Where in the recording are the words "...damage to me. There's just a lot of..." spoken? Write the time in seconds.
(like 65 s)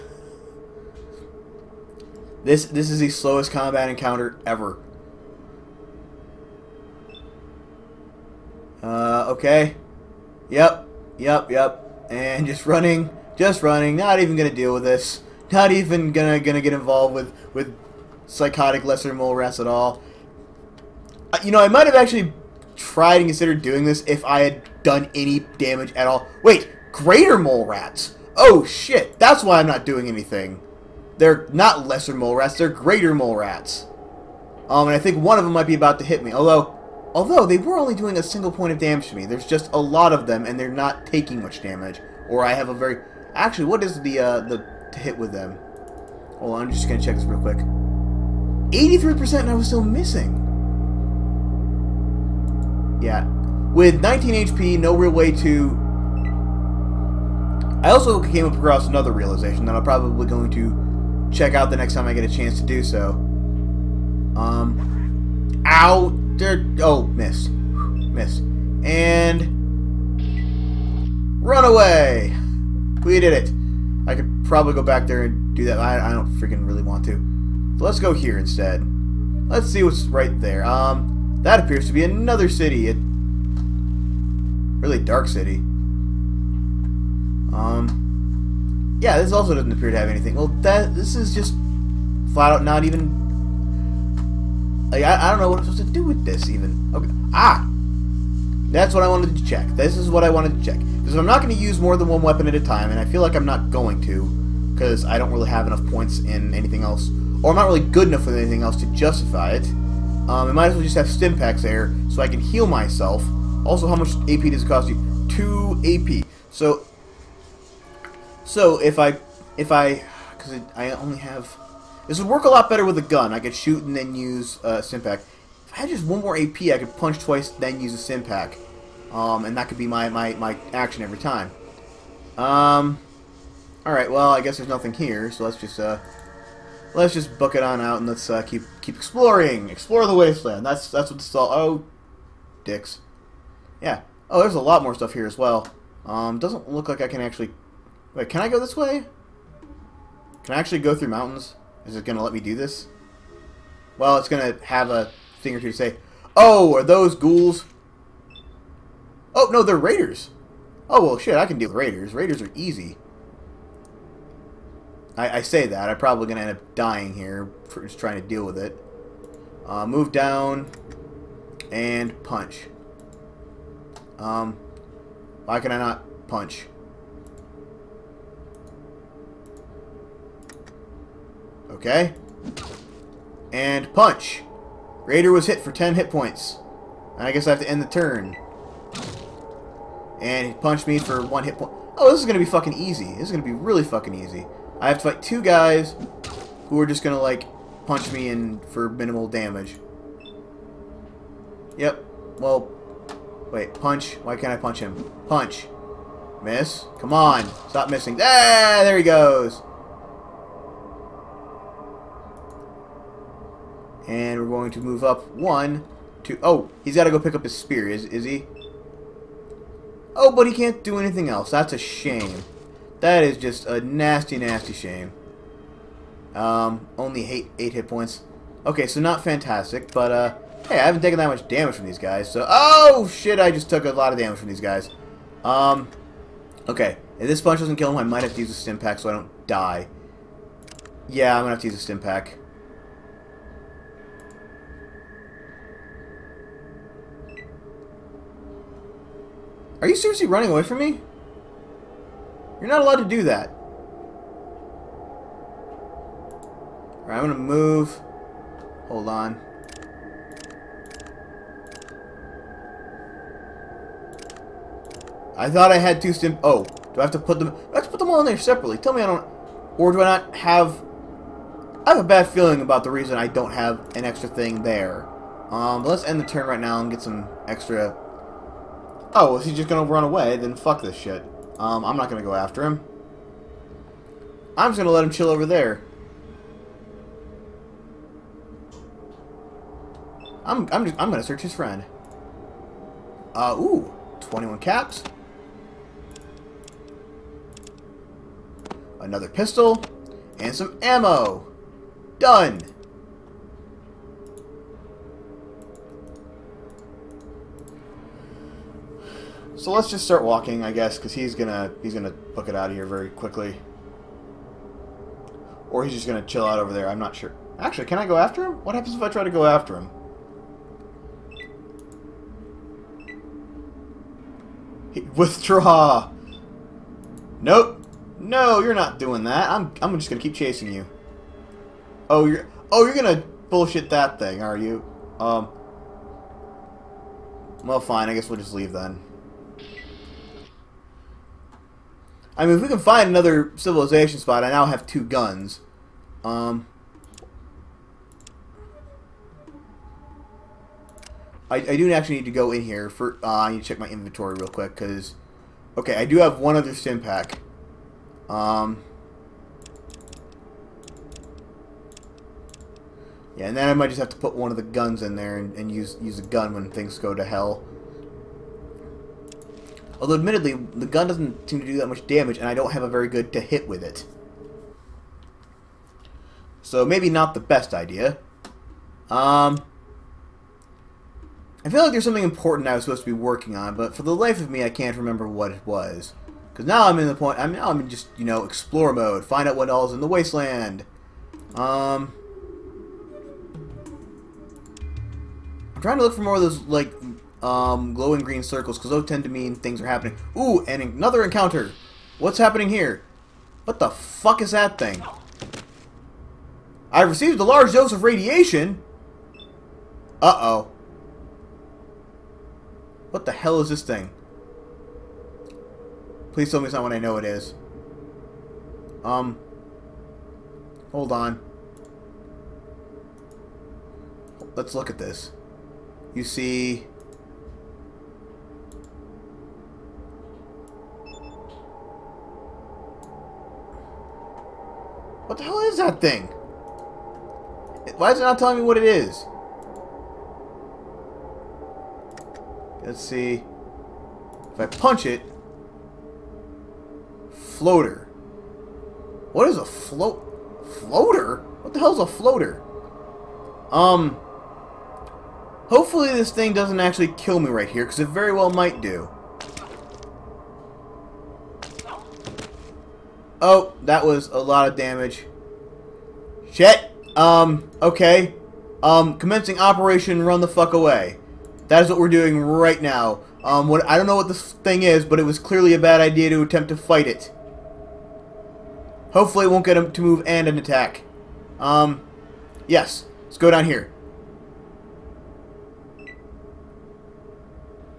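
38 s.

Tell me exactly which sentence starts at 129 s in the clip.
Um, and that could be my, my, my action every time.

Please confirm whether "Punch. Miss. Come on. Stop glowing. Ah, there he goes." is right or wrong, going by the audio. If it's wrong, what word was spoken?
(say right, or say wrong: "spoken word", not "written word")
wrong: "missing", not "glowing".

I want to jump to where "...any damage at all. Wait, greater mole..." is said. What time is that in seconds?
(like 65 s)
25 s.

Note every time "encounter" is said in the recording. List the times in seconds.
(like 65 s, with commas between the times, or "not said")
3 s, 401 s.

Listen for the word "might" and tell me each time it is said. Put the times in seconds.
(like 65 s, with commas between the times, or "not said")
21 s, 35 s, 110 s, 238 s, 363 s, 458 s.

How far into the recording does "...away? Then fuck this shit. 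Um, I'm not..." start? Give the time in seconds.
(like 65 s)
280 s.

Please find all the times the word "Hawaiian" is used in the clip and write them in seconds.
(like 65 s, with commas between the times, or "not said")
not said.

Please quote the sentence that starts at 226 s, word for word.
Um, only eight, eight hit points.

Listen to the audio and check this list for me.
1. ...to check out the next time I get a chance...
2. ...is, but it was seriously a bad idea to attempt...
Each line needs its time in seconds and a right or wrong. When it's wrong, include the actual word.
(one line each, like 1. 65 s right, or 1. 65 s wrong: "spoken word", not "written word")
1. 60 s right
2. 474 s wrong: "clearly", not "seriously".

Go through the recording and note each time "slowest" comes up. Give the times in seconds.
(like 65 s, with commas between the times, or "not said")
3 s.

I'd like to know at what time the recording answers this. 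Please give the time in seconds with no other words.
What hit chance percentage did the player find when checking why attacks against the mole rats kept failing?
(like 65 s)
48 s.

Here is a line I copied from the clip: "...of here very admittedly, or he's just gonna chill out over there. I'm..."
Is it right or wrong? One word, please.
wrong.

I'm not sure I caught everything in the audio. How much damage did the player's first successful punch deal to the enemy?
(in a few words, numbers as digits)
10 hit points.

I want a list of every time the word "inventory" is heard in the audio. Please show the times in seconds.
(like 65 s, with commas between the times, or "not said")
353 s.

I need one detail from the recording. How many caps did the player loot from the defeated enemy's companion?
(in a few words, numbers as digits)
21.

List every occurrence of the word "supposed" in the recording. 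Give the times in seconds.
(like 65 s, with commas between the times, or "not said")
95 s, 382 s.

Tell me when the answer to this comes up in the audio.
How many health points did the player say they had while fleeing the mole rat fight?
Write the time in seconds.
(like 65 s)
54 s.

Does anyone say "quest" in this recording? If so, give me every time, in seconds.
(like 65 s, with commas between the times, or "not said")
not said.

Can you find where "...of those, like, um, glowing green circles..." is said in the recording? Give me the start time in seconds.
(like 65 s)
396 s.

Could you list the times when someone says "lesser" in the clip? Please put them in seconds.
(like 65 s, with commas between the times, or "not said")
18 s, 31 s.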